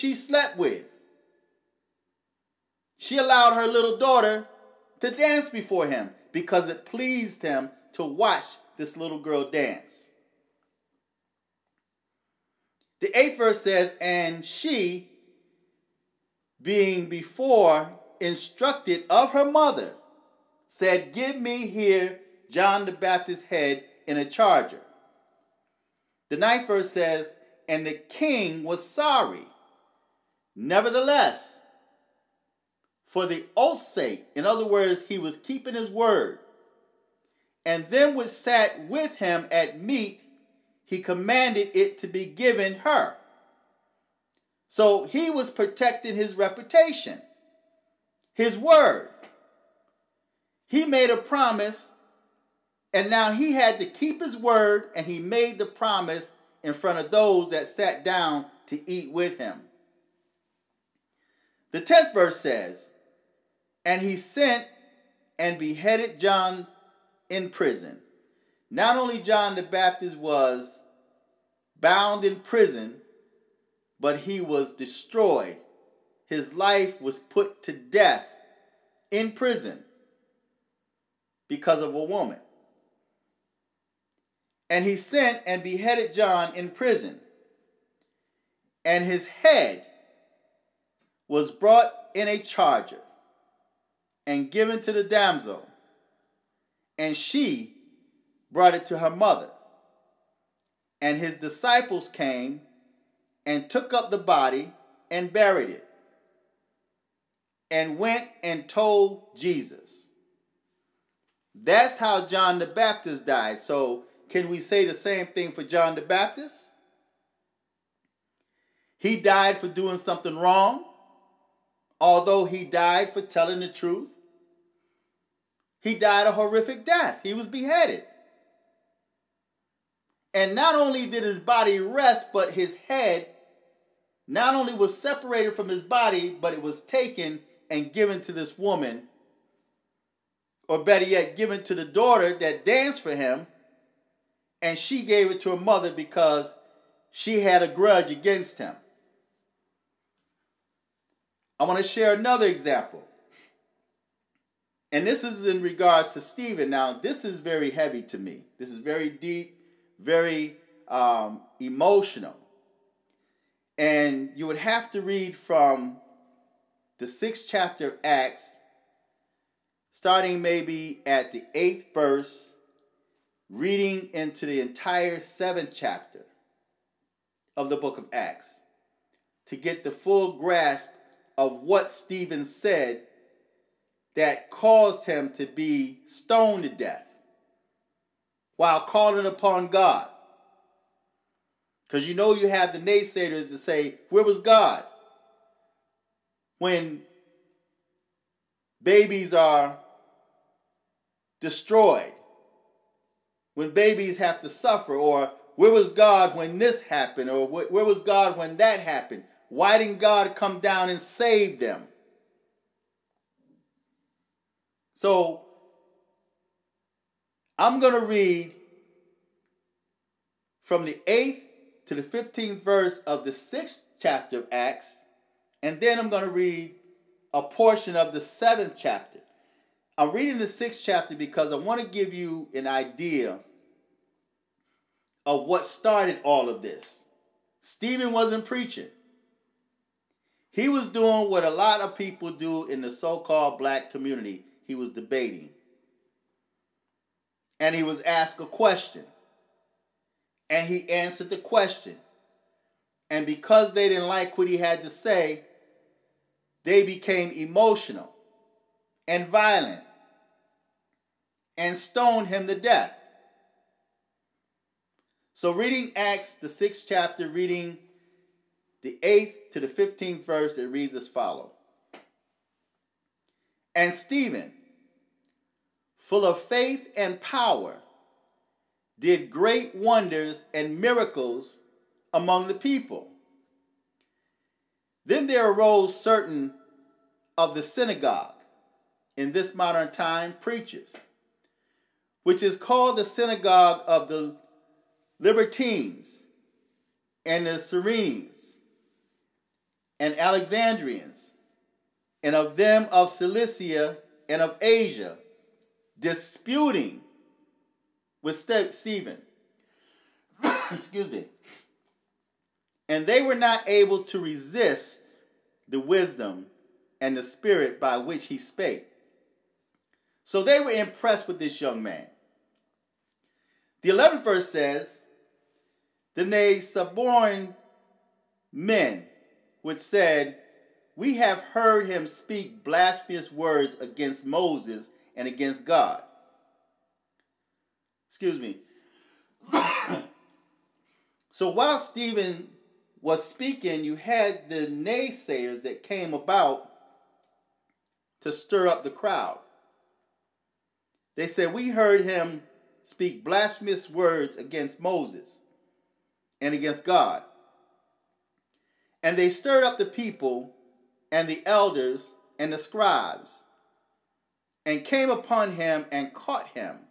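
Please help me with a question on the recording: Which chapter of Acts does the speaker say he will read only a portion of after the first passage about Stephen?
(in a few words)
7th chapter.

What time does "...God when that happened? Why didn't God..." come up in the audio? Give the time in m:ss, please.
3:28.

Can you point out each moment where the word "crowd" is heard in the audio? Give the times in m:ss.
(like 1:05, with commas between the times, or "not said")
5:48.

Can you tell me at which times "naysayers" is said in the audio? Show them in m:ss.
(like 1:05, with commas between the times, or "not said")
3:12, 5:44.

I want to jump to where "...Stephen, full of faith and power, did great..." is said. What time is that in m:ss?
4:33.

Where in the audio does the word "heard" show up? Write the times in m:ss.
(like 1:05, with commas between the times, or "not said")
5:31, 5:51.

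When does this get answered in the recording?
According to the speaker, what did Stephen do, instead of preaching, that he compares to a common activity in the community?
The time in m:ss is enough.
4:04.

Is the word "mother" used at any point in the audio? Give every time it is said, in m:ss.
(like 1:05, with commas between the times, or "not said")
0:19, 1:39, 2:25.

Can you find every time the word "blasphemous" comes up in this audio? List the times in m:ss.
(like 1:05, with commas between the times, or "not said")
5:32, 5:53.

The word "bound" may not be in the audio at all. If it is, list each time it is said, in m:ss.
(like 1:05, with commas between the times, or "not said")
1:11.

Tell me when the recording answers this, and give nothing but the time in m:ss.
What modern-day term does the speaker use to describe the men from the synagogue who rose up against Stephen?
4:50.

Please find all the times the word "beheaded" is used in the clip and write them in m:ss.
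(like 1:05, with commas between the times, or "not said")
1:05, 1:25, 2:07.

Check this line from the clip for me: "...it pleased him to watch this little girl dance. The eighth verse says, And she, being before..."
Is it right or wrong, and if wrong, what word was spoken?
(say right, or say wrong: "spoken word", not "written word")
right.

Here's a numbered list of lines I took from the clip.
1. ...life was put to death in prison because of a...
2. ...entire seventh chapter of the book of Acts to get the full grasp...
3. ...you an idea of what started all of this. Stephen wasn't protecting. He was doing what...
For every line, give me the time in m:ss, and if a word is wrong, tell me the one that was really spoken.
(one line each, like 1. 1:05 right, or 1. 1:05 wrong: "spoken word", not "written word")
1. 1:16 right
2. 2:54 right
3. 3:52 wrong: "preaching", not "protecting".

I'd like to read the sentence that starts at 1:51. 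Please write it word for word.
That's how John the Baptist died.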